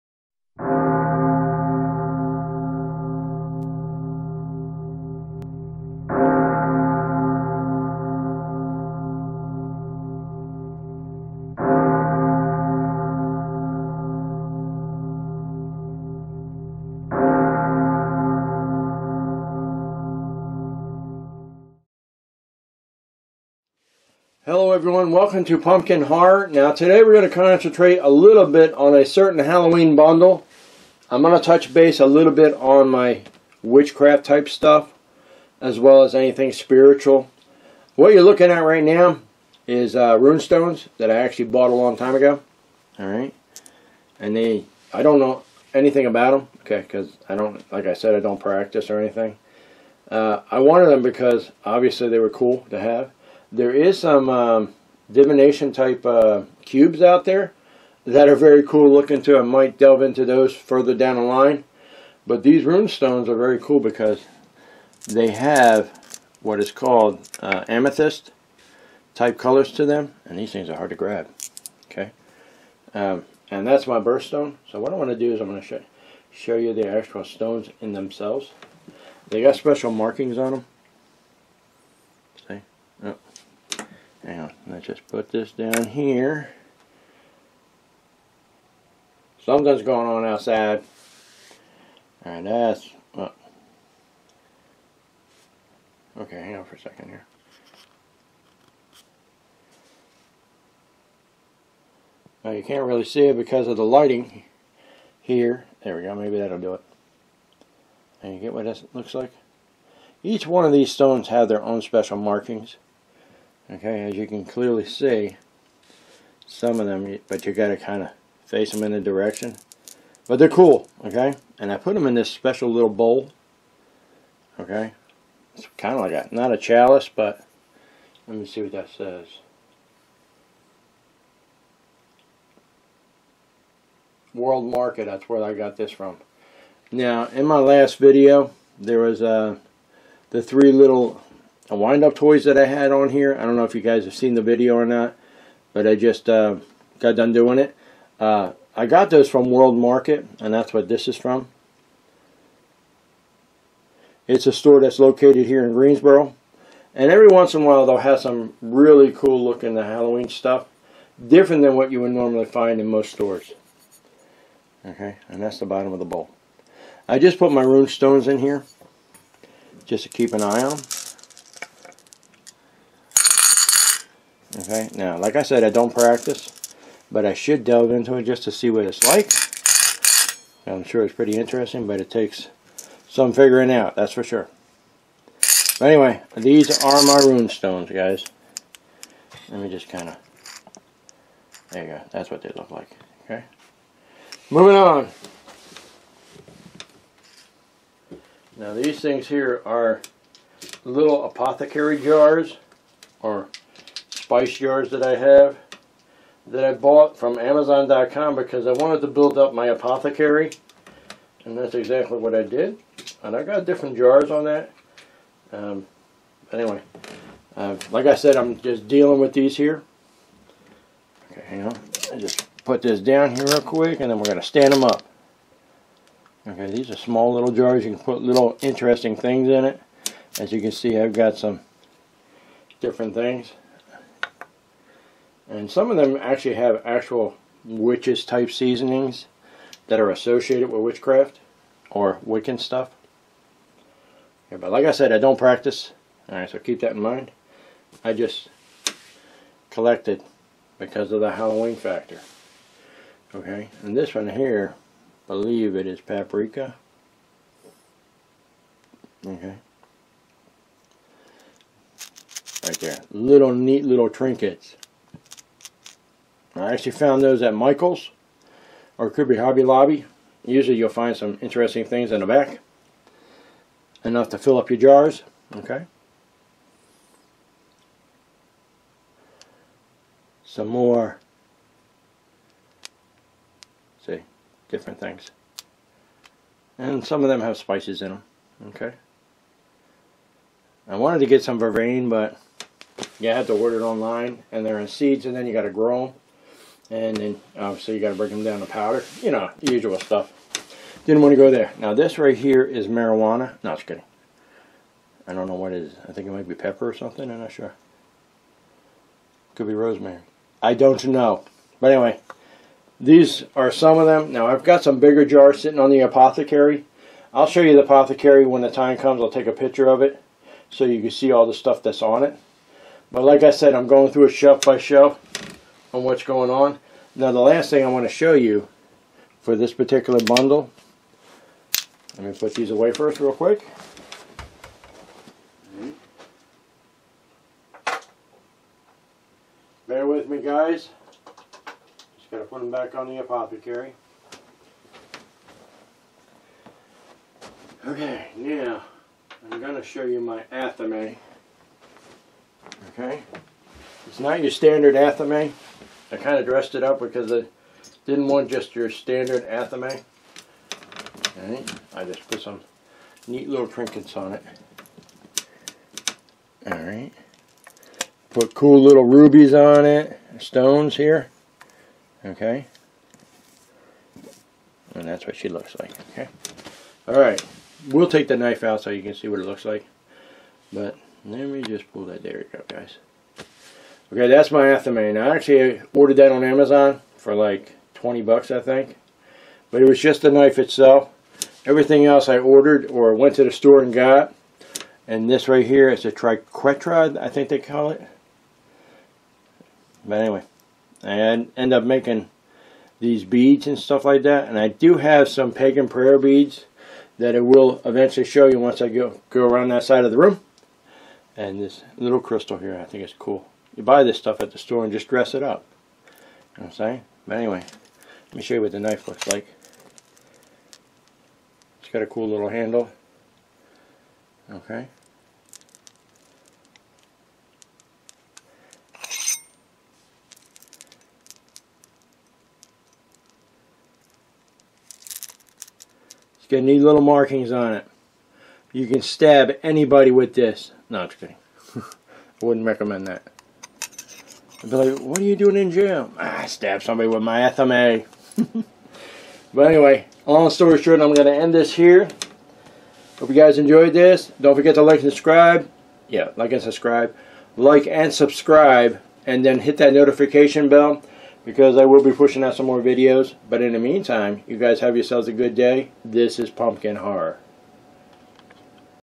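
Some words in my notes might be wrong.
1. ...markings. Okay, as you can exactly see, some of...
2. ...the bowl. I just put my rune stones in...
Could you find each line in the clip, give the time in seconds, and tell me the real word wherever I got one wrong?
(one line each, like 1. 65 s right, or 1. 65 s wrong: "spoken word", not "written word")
1. 112 s wrong: "clearly", not "exactly"
2. 165 s right.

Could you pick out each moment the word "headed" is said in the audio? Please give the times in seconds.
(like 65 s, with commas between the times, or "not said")
not said.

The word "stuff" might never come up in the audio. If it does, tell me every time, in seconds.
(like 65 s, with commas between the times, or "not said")
34 s, 160 s, 242 s, 299 s, 321 s, 403 s, 414 s.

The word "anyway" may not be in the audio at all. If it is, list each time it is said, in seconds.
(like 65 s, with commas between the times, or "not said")
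185 s, 216 s, 311 s, 400 s, 417 s, 449 s.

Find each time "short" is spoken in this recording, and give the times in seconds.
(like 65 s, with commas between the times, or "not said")
450 s.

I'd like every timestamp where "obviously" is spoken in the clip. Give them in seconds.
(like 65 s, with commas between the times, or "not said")
51 s, 297 s.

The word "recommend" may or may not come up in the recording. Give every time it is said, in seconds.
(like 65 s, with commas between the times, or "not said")
442 s.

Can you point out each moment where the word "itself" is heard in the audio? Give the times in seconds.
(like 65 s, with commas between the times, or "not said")
390 s.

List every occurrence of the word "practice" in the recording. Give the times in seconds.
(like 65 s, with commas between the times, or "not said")
48 s, 175 s, 245 s.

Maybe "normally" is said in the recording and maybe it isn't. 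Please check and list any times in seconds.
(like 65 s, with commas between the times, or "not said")
162 s.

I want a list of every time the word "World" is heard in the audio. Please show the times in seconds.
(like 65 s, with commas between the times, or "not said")
134 s, 149 s.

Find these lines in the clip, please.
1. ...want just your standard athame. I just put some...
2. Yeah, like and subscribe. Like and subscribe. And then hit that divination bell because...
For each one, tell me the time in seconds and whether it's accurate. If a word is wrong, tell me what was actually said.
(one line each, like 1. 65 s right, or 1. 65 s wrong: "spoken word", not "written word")
1. 358 s right
2. 456 s wrong: "notification", not "divination".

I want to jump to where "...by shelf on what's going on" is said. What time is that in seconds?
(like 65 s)
324 s.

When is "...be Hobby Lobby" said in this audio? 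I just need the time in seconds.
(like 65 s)
269 s.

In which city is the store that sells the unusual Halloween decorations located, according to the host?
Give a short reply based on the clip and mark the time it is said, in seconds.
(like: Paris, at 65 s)
Greensboro, at 155 s.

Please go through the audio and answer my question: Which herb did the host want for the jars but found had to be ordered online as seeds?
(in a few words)
Vervain.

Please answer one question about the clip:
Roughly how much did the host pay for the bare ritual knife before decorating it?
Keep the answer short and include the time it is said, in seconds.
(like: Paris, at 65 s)
$20, at 387 s.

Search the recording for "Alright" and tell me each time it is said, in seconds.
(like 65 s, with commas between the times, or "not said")
42 s, 246 s, 366 s, 377 s.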